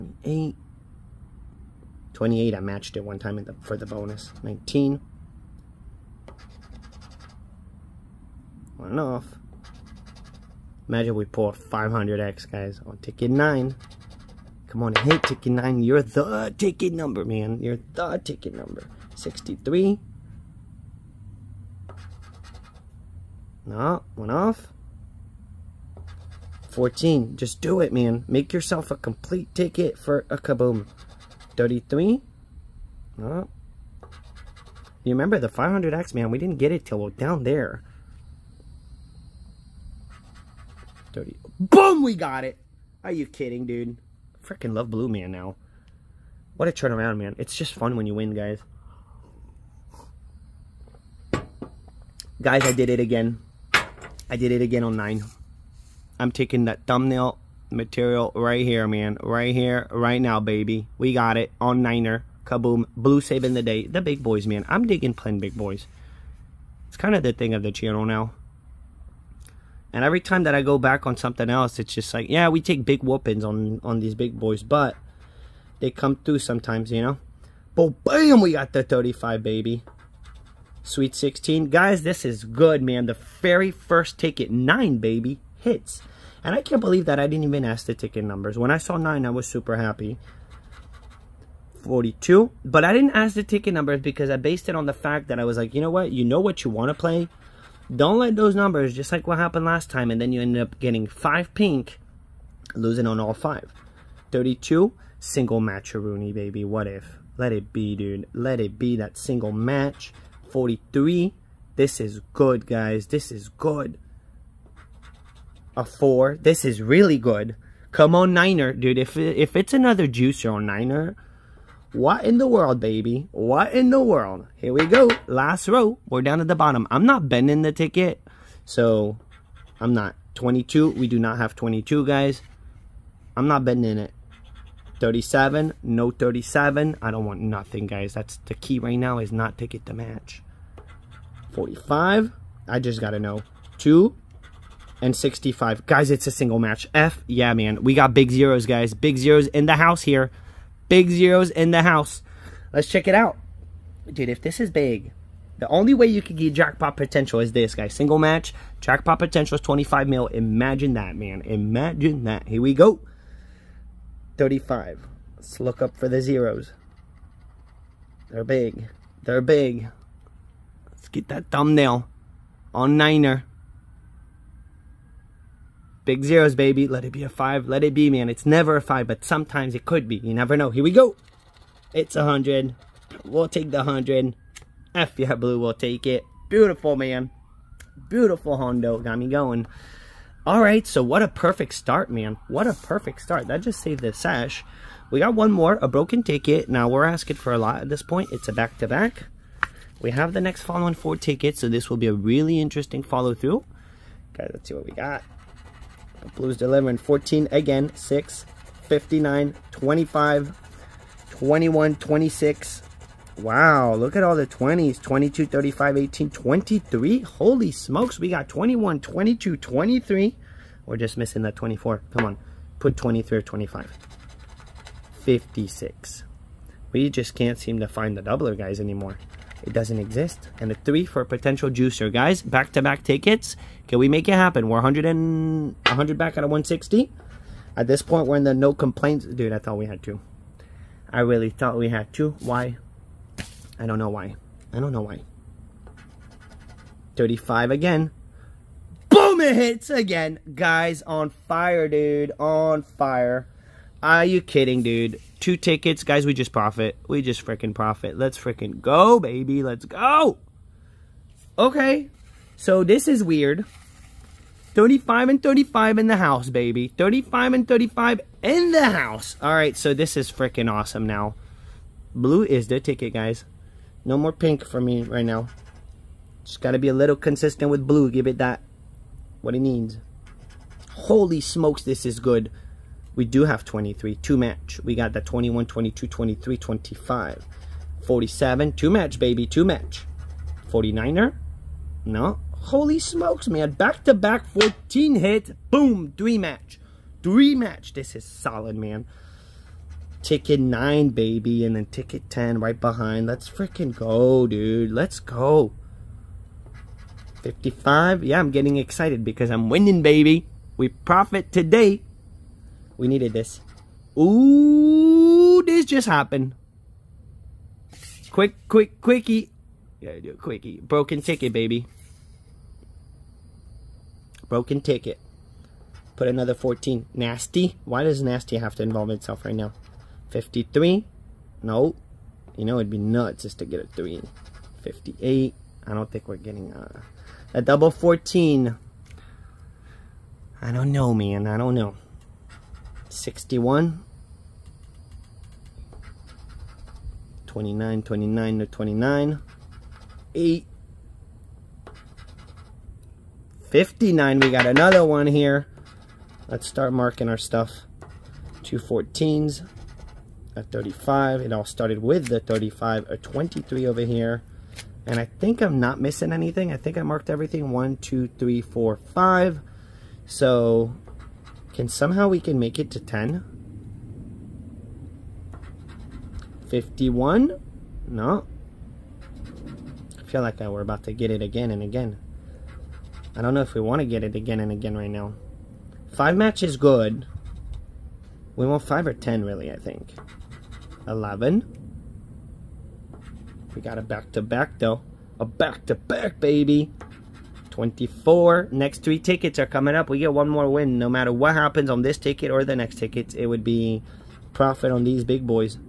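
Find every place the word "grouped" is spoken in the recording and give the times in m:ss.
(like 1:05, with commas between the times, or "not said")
not said.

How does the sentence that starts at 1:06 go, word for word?
It's kind of the thing of the channel now.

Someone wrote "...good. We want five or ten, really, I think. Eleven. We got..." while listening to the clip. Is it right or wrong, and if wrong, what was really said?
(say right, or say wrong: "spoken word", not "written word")
right.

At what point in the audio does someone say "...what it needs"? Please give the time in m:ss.
4:39.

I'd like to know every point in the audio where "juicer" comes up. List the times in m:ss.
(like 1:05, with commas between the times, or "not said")
2:00, 3:51.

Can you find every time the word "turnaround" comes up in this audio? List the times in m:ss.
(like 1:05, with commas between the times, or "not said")
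0:46.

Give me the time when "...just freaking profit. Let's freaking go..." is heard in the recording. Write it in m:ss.
4:17.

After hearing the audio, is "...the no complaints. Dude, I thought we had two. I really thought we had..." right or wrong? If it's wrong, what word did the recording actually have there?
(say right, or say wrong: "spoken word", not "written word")
right.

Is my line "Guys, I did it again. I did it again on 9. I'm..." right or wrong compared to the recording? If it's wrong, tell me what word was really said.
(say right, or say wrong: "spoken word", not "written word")
right.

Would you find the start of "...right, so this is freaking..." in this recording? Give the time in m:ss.
4:29.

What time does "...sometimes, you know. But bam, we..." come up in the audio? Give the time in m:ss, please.
1:16.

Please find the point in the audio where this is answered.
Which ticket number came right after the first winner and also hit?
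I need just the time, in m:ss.
5:01.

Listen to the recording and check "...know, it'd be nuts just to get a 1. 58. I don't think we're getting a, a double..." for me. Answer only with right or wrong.
wrong.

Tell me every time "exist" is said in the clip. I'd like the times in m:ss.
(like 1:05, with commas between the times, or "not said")
3:49.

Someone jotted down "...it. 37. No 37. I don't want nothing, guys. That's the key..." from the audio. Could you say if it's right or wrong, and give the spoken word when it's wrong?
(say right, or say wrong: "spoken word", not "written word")
right.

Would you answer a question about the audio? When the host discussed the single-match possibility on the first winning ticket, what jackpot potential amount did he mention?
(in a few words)
25 mil.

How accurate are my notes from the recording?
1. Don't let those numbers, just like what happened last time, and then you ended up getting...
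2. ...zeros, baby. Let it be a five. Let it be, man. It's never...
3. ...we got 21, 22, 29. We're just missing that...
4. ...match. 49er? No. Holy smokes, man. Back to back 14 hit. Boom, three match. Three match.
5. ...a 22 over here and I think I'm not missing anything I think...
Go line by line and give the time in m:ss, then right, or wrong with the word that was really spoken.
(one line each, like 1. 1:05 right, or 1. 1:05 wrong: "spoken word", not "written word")
1. 1:37 right
2. 2:56 right
3. 3:38 wrong: "23", not "29"
4. 4:49 right
5. 6:03 wrong: "23", not "22".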